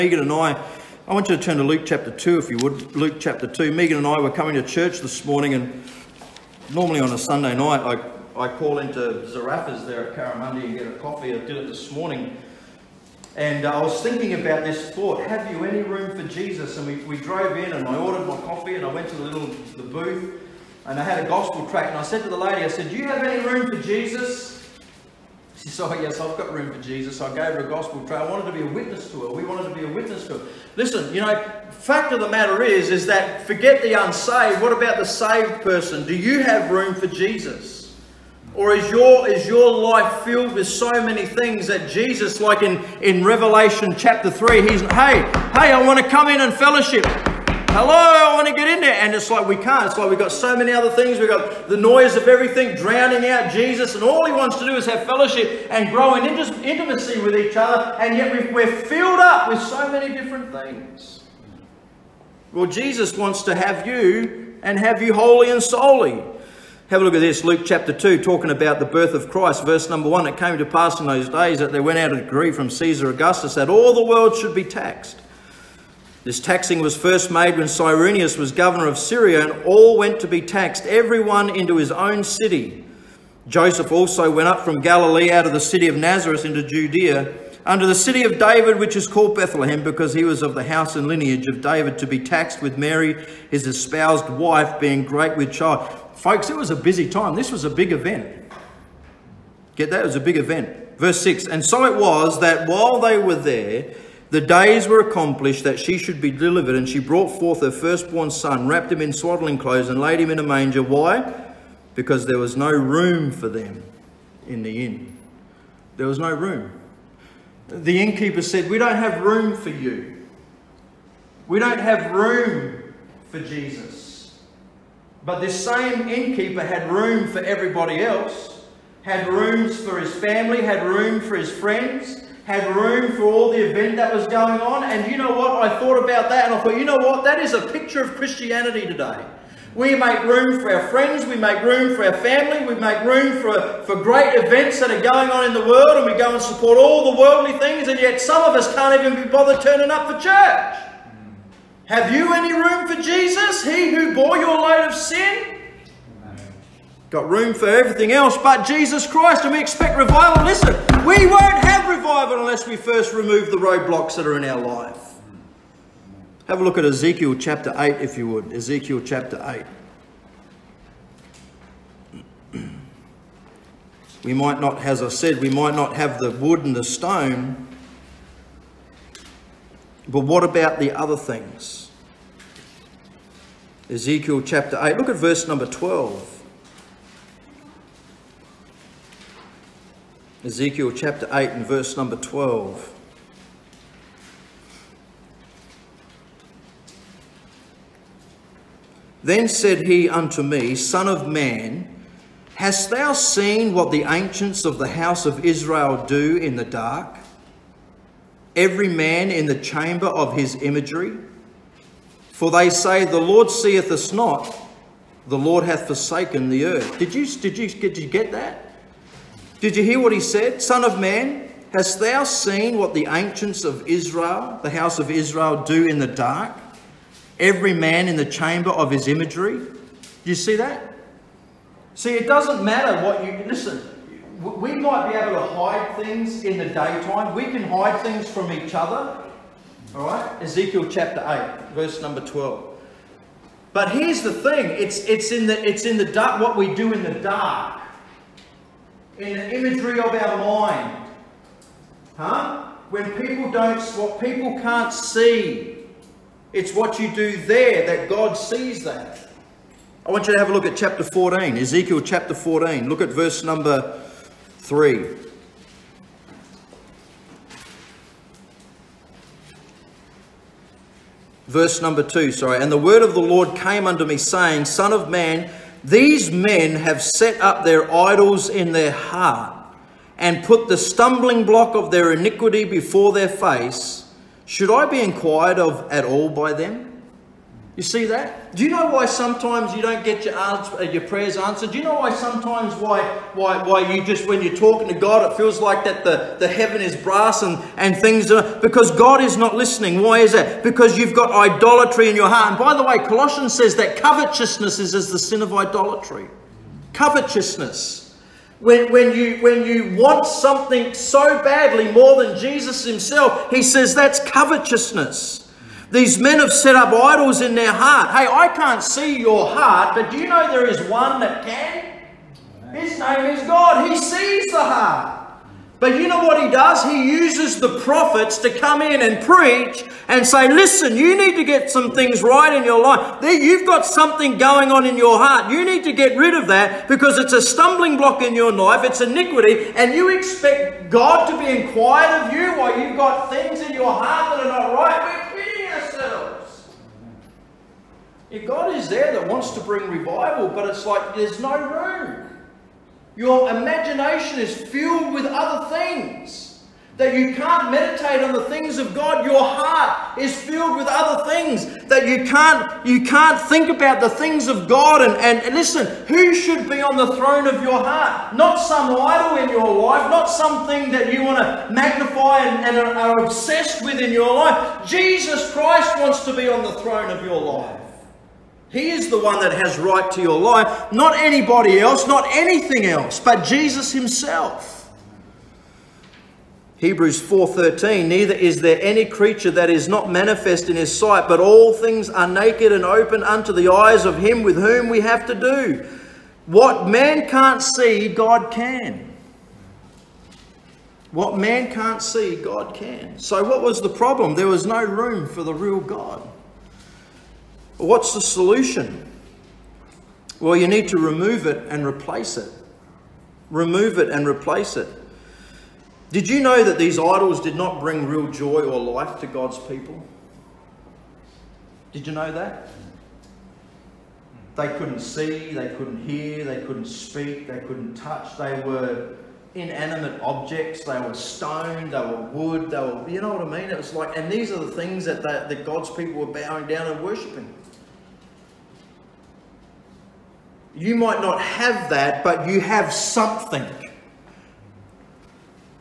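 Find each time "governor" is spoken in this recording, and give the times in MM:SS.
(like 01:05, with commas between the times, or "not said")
01:18.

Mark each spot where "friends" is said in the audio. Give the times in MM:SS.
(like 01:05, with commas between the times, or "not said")
02:11, 02:20.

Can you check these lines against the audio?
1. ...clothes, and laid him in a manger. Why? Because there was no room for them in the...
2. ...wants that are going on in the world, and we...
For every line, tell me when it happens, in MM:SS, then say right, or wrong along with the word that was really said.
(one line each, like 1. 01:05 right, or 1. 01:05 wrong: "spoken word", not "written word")
1. 01:49 right
2. 02:24 wrong: "events", not "wants".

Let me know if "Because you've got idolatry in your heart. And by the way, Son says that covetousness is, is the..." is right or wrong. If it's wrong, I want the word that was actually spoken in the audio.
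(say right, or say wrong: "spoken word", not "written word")
wrong: "Colossians", not "Son".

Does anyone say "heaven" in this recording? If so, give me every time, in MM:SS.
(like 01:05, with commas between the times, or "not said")
04:56.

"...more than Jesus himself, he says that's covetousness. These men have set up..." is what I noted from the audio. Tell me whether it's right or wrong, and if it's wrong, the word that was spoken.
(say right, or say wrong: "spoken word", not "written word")
right.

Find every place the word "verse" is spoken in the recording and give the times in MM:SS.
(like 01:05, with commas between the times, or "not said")
01:09, 01:40, 03:05, 03:11, 04:01, 04:23, 04:31.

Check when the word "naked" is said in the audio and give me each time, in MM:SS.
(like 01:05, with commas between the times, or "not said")
06:32.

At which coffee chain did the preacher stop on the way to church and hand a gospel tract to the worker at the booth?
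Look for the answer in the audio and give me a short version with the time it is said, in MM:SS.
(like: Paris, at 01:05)
Zarraffa's, at 00:09.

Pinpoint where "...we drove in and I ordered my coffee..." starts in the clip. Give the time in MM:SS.
00:17.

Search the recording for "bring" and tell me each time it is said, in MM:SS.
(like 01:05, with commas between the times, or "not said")
05:49, 06:57.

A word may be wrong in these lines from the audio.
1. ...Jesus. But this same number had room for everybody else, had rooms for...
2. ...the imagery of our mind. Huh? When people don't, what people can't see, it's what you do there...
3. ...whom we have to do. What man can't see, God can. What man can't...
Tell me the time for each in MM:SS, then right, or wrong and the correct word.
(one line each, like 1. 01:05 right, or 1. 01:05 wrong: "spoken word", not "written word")
1. 02:03 wrong: "innkeeper", not "number"
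2. 04:09 right
3. 06:34 right.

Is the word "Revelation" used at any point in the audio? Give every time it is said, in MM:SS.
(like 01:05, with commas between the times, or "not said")
00:43.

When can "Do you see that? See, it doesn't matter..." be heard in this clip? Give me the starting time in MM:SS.
03:49.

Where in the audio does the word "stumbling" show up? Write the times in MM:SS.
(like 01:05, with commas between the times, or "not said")
04:40, 05:37.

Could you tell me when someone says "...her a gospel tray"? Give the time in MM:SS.
00:27.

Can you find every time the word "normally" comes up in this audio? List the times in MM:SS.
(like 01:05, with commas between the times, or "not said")
00:06.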